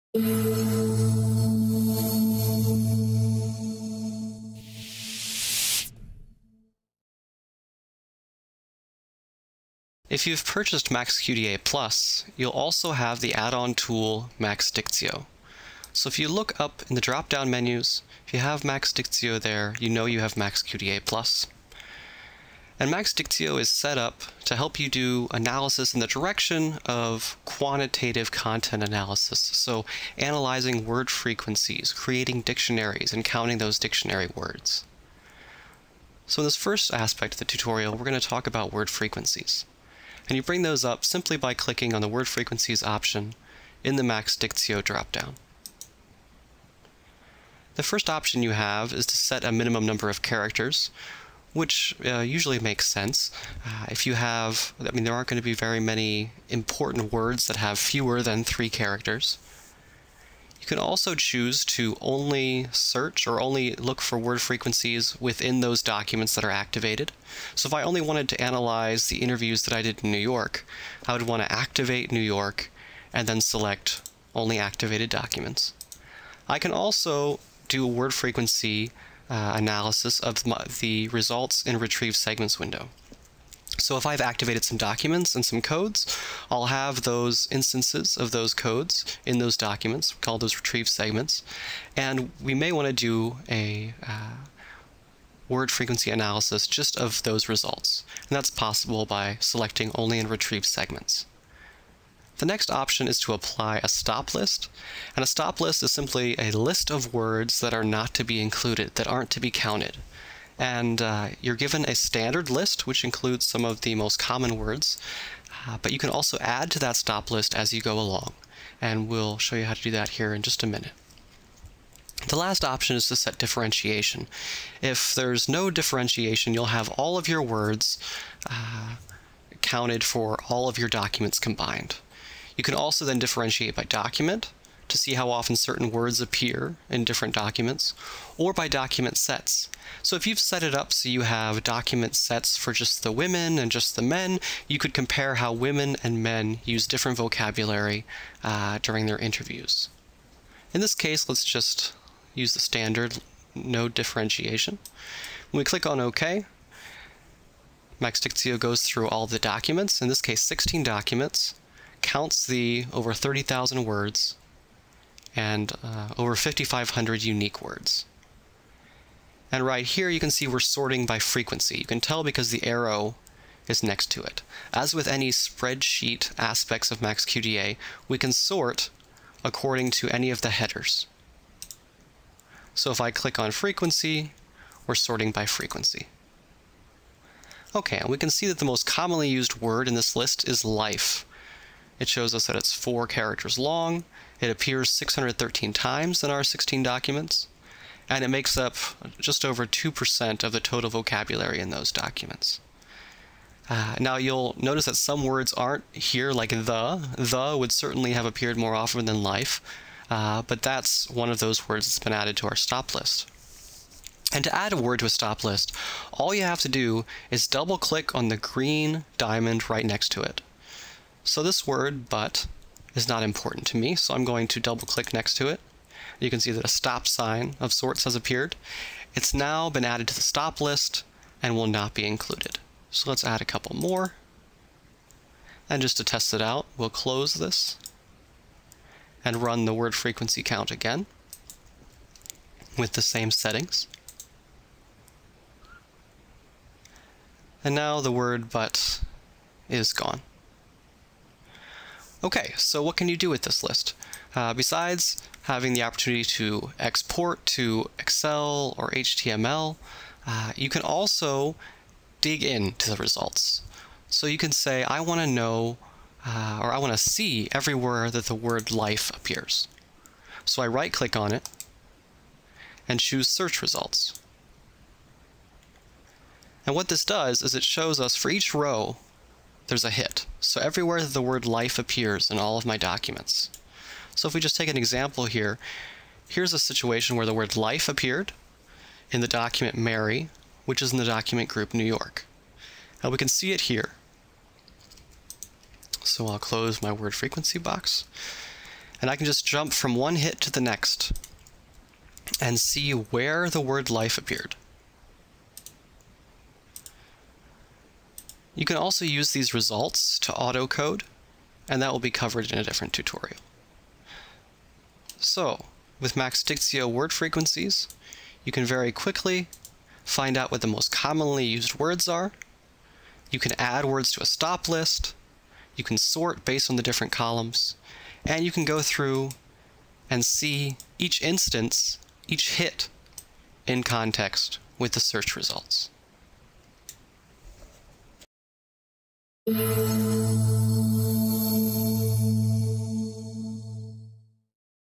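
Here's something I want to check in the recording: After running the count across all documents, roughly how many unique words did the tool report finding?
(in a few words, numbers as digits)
over 5,500.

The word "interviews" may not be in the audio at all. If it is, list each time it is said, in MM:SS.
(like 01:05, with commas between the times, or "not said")
01:09, 02:29.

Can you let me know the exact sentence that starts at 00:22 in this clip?
And Max Dictio is set up to help you do analysis in the direction of quantitative content analysis.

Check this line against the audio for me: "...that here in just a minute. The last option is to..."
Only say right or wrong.
right.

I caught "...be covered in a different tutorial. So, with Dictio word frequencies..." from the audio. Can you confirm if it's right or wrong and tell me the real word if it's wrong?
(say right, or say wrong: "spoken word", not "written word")
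wrong: "Maxdictio", not "Dictio".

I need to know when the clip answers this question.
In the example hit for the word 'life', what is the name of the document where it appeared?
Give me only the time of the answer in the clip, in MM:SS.
04:49.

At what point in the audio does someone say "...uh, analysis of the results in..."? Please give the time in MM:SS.
01:19.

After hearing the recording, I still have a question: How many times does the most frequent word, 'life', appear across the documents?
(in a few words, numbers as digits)
613.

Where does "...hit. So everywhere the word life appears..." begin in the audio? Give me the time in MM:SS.
04:39.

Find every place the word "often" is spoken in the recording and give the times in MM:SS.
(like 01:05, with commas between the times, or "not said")
02:15, 03:28.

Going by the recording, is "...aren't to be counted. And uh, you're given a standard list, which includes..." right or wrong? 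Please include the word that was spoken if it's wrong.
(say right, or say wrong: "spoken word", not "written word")
right.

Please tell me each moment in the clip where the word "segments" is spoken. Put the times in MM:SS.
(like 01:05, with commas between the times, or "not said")
01:22, 01:30, 01:40.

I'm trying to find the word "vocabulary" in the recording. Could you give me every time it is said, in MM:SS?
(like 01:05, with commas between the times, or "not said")
02:27, 03:20.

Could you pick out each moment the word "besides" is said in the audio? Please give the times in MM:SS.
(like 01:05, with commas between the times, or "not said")
04:14.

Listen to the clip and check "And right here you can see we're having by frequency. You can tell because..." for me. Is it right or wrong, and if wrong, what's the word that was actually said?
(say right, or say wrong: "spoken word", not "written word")
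wrong: "sorting", not "having".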